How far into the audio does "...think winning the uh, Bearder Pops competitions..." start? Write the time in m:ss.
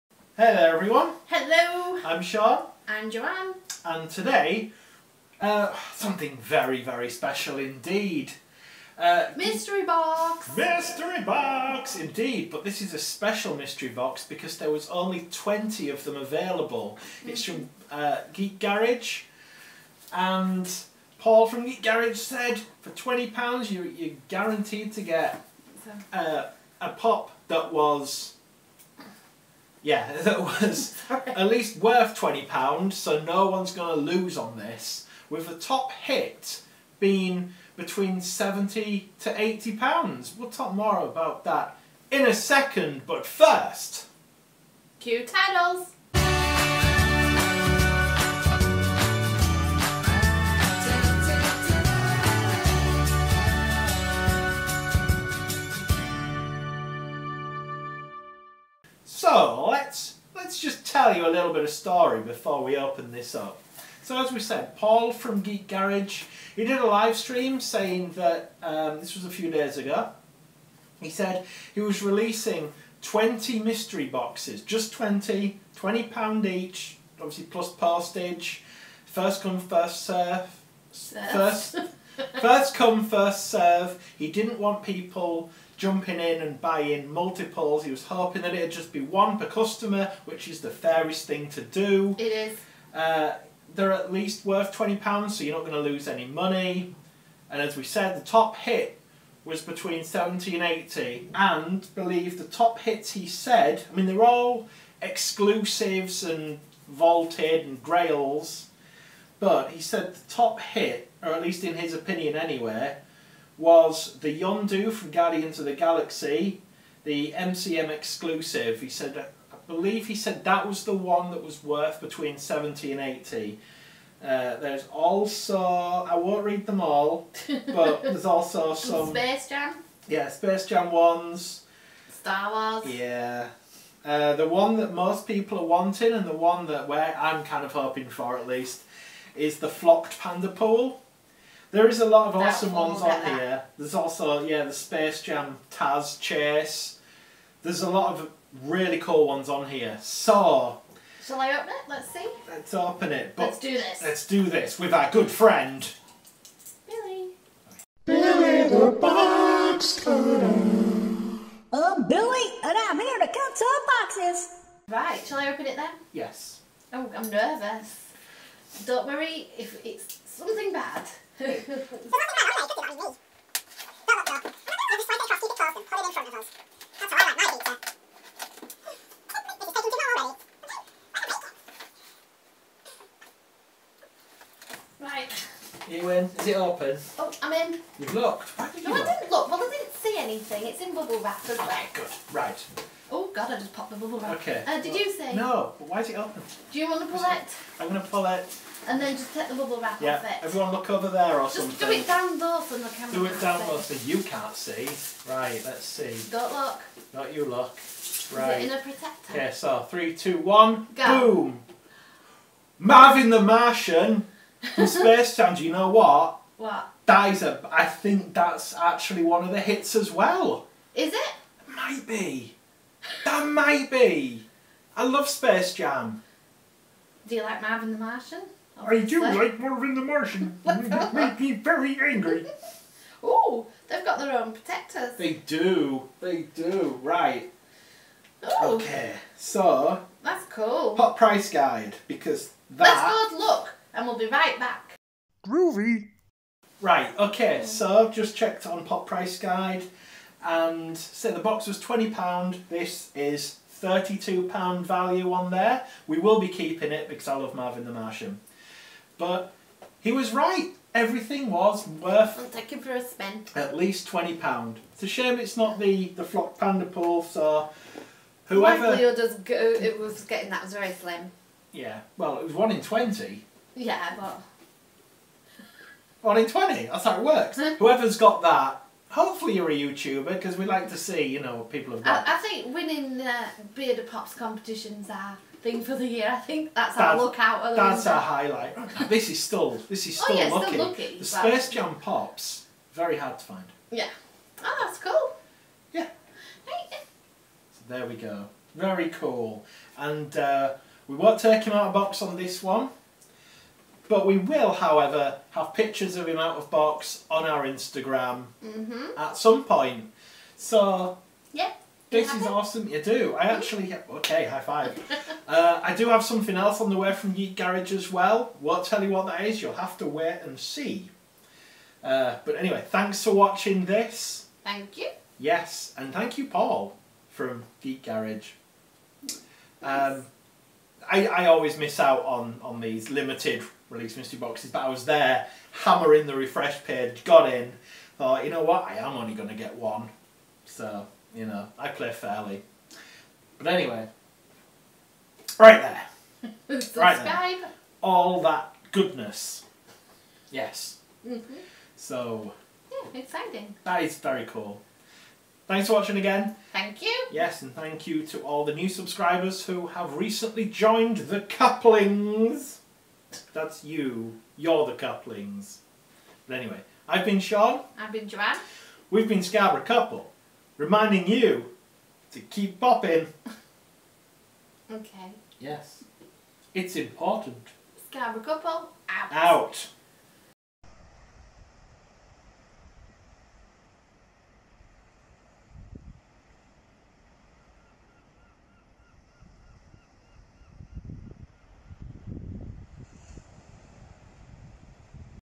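4:42.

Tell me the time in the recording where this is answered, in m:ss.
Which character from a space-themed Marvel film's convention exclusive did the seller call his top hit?
1:54.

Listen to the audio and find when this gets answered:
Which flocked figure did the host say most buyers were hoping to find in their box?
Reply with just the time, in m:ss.
2:20.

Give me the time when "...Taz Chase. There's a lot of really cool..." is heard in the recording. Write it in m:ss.
2:25.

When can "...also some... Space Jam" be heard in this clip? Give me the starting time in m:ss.
2:08.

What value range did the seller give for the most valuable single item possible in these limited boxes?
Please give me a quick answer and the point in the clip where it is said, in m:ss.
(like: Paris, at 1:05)
£70 to £80, at 0:37.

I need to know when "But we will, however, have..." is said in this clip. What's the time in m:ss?
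5:04.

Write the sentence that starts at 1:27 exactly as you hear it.
He was hoping that it'd just be one per customer, which is the fairest thing to do.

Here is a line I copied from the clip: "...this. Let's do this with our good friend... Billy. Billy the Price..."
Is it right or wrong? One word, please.
wrong.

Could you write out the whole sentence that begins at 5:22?
Uh, but anyway, thanks for watching this.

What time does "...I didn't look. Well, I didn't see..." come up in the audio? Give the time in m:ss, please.
3:08.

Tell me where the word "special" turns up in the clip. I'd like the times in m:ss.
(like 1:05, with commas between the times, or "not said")
0:07, 0:12.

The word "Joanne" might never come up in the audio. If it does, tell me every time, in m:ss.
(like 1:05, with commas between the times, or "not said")
0:03, 6:08.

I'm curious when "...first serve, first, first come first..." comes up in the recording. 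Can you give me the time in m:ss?
1:19.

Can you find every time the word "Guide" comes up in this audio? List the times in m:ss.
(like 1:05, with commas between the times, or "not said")
4:01, 4:09.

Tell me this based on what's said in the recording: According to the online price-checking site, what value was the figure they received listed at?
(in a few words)
£32.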